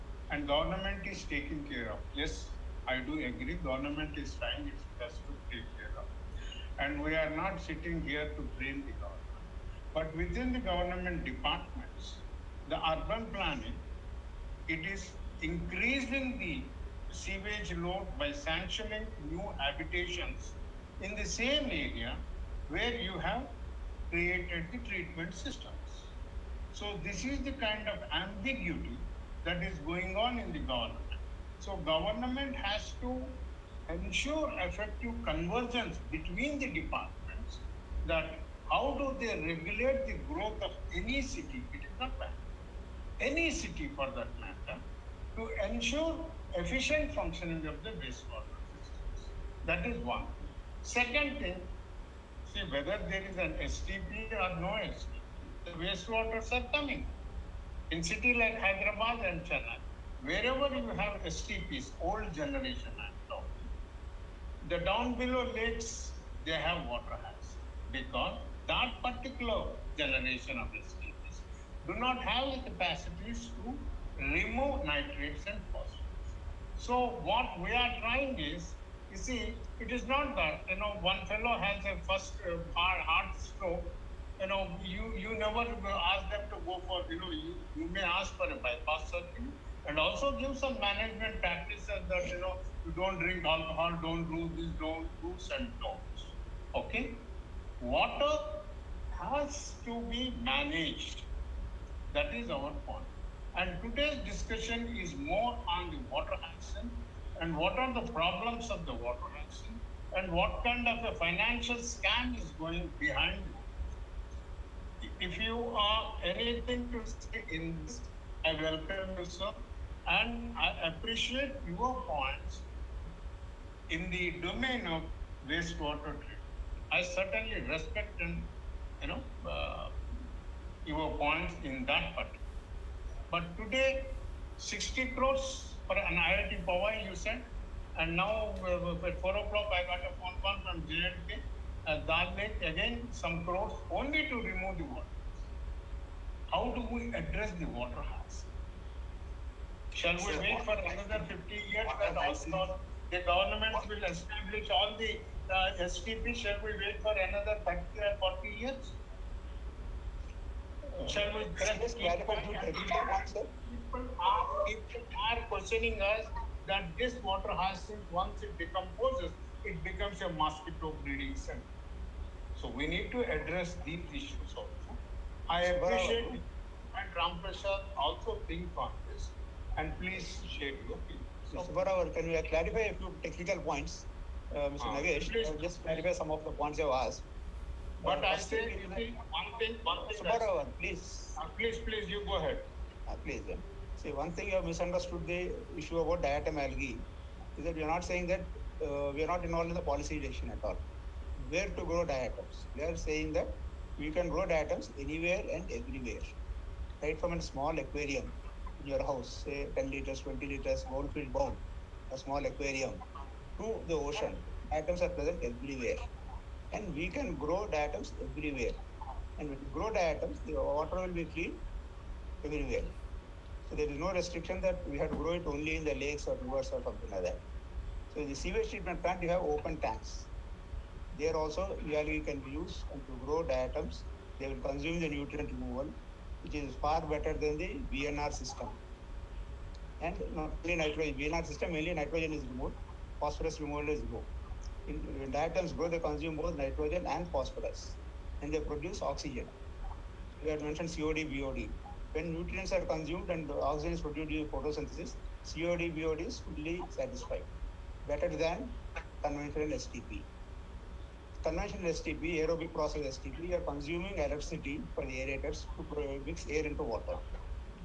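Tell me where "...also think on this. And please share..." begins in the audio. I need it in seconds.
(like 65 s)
177 s.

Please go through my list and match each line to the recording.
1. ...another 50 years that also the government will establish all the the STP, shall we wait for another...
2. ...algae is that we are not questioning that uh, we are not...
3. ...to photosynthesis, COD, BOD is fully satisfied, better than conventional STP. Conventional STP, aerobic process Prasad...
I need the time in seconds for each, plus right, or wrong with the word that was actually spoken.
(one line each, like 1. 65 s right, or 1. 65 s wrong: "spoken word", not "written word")
1. 150 s right
2. 196 s wrong: "saying", not "questioning"
3. 254 s wrong: "STP", not "Prasad".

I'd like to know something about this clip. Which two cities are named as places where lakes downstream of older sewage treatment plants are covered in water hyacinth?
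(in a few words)
Hyderabad and Chennai.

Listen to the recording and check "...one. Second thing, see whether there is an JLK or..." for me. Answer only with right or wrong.
wrong.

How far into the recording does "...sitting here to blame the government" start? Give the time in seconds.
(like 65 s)
7 s.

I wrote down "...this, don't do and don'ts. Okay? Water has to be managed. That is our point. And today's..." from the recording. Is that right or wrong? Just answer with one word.
right.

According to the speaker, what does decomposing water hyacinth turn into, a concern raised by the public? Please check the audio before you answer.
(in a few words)
Mosquito breeding center.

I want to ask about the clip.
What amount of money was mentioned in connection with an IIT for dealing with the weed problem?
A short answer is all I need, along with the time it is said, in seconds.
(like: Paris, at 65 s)
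60 crores, at 134 s.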